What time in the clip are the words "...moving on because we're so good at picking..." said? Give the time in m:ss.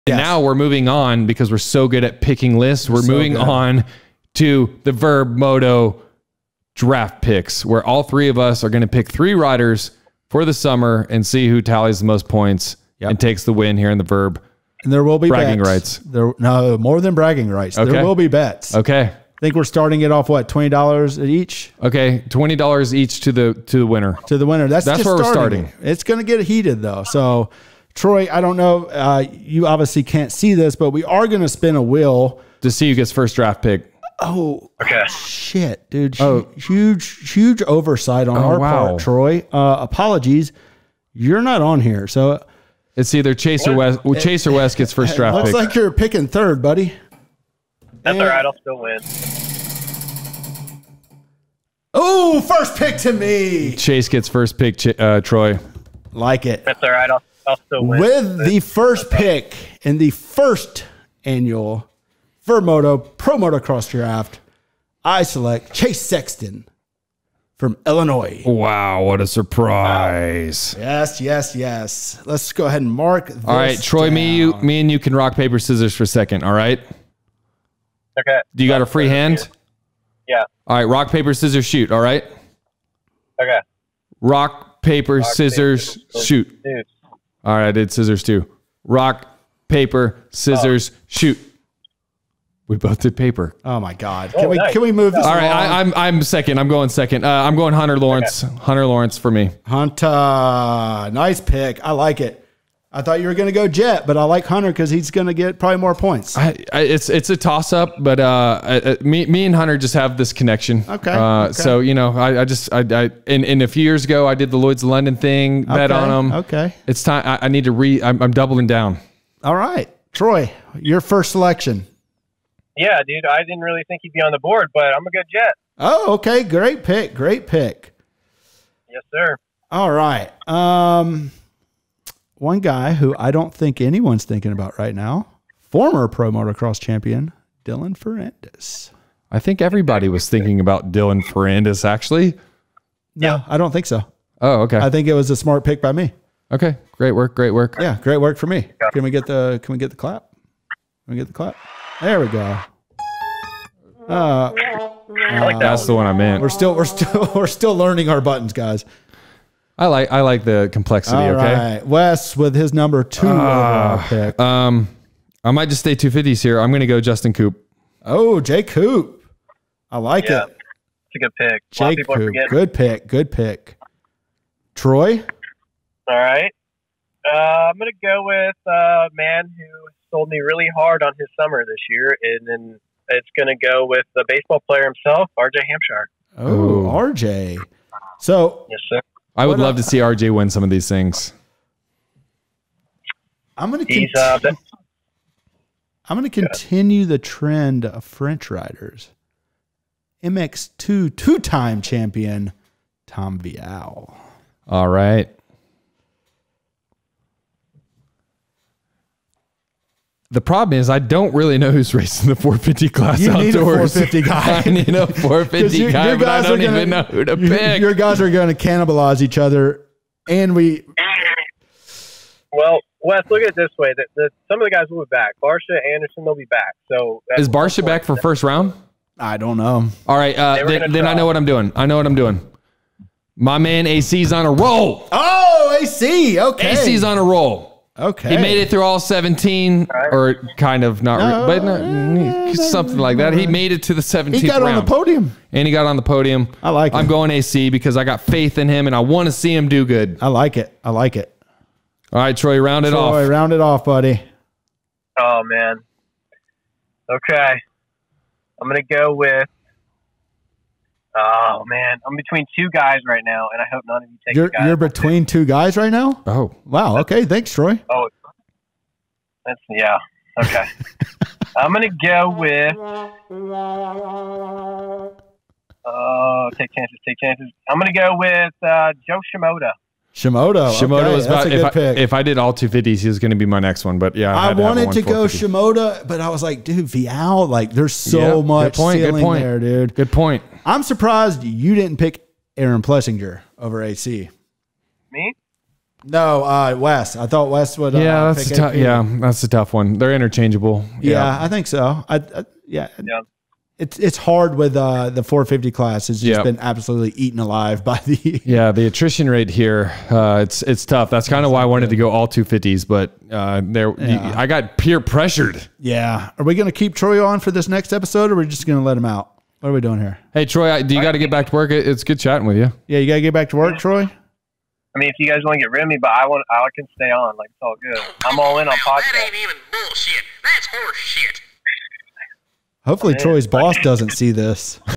0:00.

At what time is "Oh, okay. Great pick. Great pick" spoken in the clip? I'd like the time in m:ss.
2:05.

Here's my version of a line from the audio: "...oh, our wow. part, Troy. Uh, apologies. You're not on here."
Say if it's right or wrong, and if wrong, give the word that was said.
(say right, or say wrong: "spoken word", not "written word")
right.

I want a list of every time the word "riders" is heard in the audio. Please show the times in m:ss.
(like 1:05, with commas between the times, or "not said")
0:09, 3:18.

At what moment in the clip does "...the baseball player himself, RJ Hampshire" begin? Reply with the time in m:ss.
3:04.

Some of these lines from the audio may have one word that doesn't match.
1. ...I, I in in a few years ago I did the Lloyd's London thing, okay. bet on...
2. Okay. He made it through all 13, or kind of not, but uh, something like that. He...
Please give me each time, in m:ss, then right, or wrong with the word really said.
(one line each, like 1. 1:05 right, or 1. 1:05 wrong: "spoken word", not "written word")
1. 1:52 right
2. 3:58 wrong: "17", not "13".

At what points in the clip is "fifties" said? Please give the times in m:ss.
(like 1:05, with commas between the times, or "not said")
2:46, 4:42.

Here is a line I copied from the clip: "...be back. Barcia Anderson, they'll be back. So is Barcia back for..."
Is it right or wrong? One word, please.
right.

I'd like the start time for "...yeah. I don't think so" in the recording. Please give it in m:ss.
2:23.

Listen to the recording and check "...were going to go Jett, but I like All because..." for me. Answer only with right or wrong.
wrong.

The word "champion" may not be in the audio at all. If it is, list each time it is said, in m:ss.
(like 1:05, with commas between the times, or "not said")
2:16, 3:21.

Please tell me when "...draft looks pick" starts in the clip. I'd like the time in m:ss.
0:45.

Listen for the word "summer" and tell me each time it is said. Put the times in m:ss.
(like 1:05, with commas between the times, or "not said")
0:10, 3:01.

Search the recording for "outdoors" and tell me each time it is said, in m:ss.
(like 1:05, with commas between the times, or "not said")
3:33.